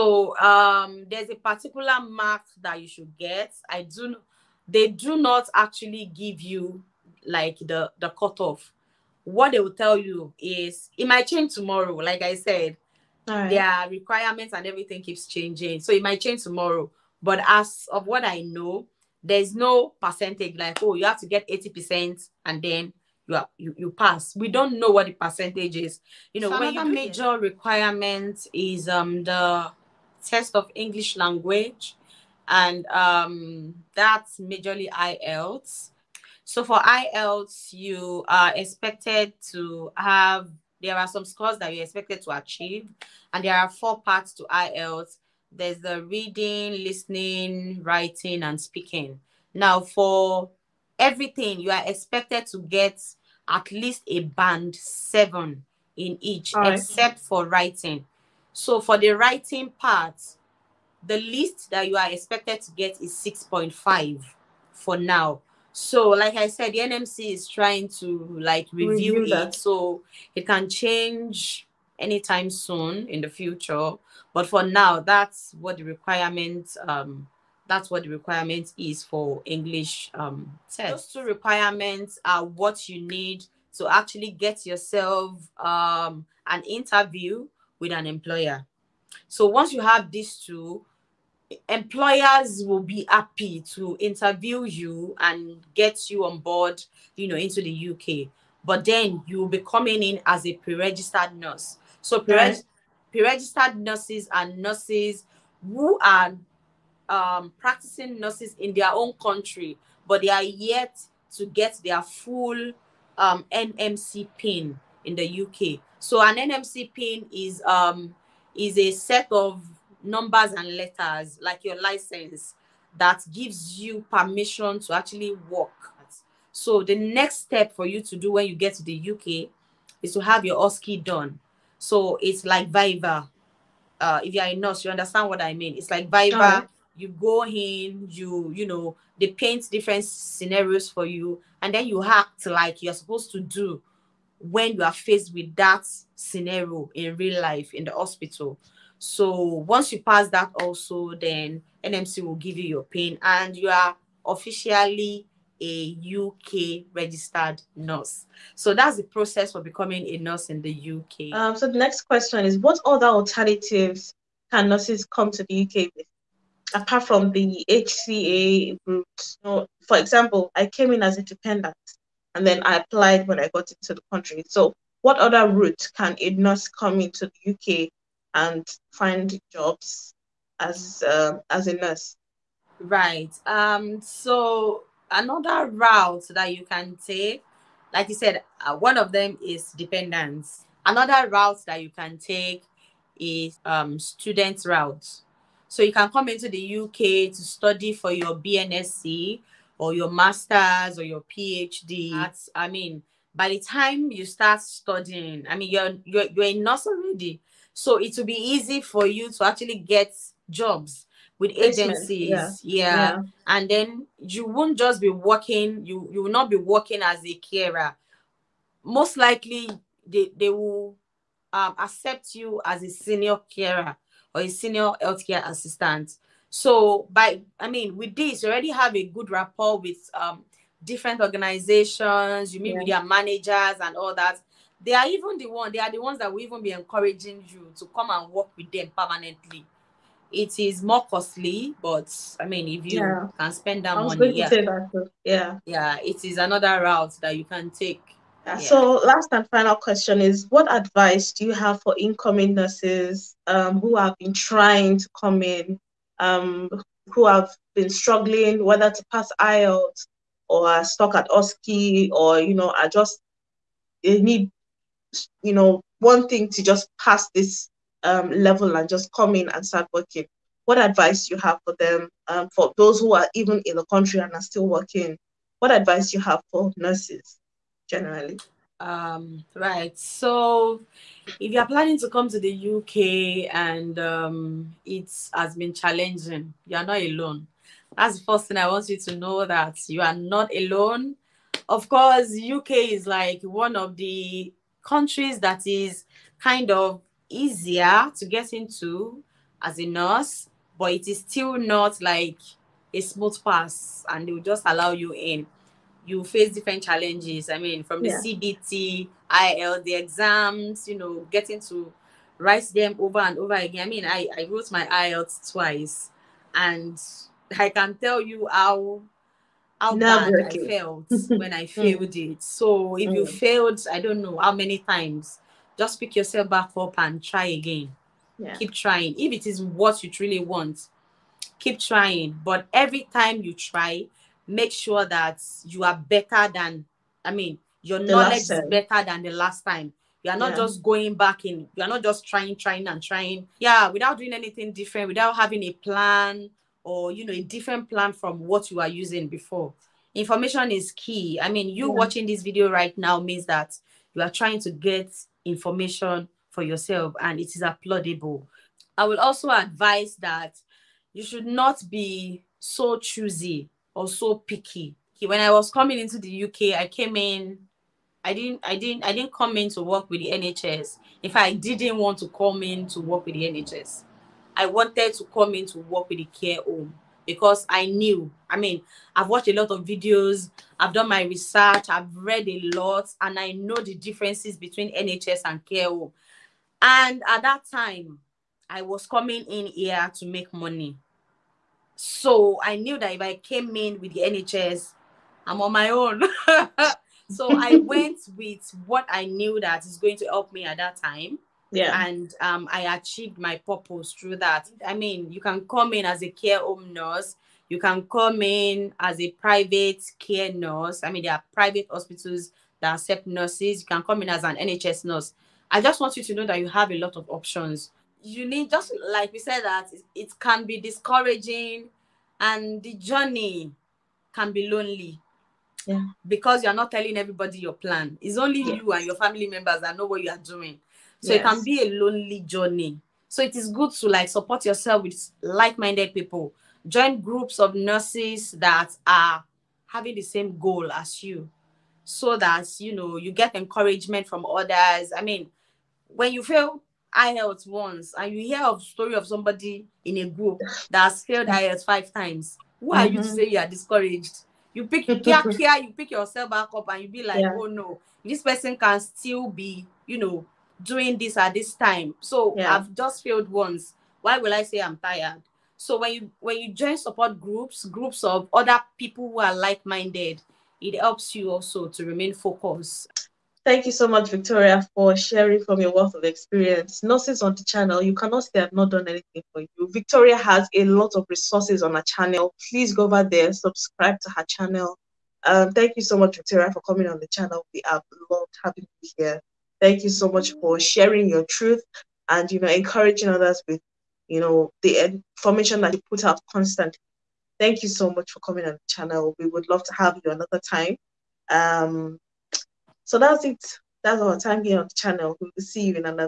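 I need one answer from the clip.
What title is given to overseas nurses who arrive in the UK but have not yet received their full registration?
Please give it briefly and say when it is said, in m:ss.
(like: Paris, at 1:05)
pre-registered nurse, at 1:40.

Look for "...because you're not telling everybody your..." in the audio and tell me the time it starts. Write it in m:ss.
7:06.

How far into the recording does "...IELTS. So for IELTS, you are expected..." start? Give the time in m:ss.
0:34.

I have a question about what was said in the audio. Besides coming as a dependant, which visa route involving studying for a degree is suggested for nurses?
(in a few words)
student route.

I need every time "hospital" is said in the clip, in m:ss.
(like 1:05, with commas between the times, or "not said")
2:27, 6:51.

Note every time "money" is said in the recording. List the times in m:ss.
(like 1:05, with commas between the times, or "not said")
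4:03, 6:30.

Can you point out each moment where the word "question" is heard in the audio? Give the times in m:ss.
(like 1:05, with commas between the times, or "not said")
2:42, 4:09.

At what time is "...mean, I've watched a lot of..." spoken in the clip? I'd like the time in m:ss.
6:18.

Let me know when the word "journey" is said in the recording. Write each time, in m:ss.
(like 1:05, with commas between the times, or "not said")
7:02, 7:12.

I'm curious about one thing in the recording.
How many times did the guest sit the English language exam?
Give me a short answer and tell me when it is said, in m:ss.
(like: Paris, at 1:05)
twice, at 5:15.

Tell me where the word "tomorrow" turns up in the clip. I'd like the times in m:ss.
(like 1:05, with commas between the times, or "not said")
0:11, 0:16.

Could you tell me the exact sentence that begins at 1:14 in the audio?
But for now, that's what the requirement um, that's what the requirement is for English um, test.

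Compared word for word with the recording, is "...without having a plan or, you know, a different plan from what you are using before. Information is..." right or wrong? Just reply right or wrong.
right.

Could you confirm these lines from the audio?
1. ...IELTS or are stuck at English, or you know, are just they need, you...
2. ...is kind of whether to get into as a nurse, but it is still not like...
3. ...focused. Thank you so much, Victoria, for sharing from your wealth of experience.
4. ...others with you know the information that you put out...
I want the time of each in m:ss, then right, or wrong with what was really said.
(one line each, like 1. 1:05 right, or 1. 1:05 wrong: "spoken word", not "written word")
1. 4:19 wrong: "OSCE", not "English"
2. 4:55 wrong: "easier", not "whether"
3. 7:52 right
4. 8:13 right.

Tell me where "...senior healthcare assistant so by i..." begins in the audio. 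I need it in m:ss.
3:44.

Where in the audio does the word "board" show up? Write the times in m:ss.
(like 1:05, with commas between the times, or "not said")
1:36.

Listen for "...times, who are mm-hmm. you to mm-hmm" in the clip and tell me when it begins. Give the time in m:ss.
7:32.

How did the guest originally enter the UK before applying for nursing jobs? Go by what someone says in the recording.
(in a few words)
as a dependent.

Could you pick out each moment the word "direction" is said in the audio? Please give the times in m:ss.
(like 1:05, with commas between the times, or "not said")
not said.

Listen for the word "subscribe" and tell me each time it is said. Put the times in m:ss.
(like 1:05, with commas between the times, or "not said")
8:03.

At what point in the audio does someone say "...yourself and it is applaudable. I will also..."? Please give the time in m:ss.
5:56.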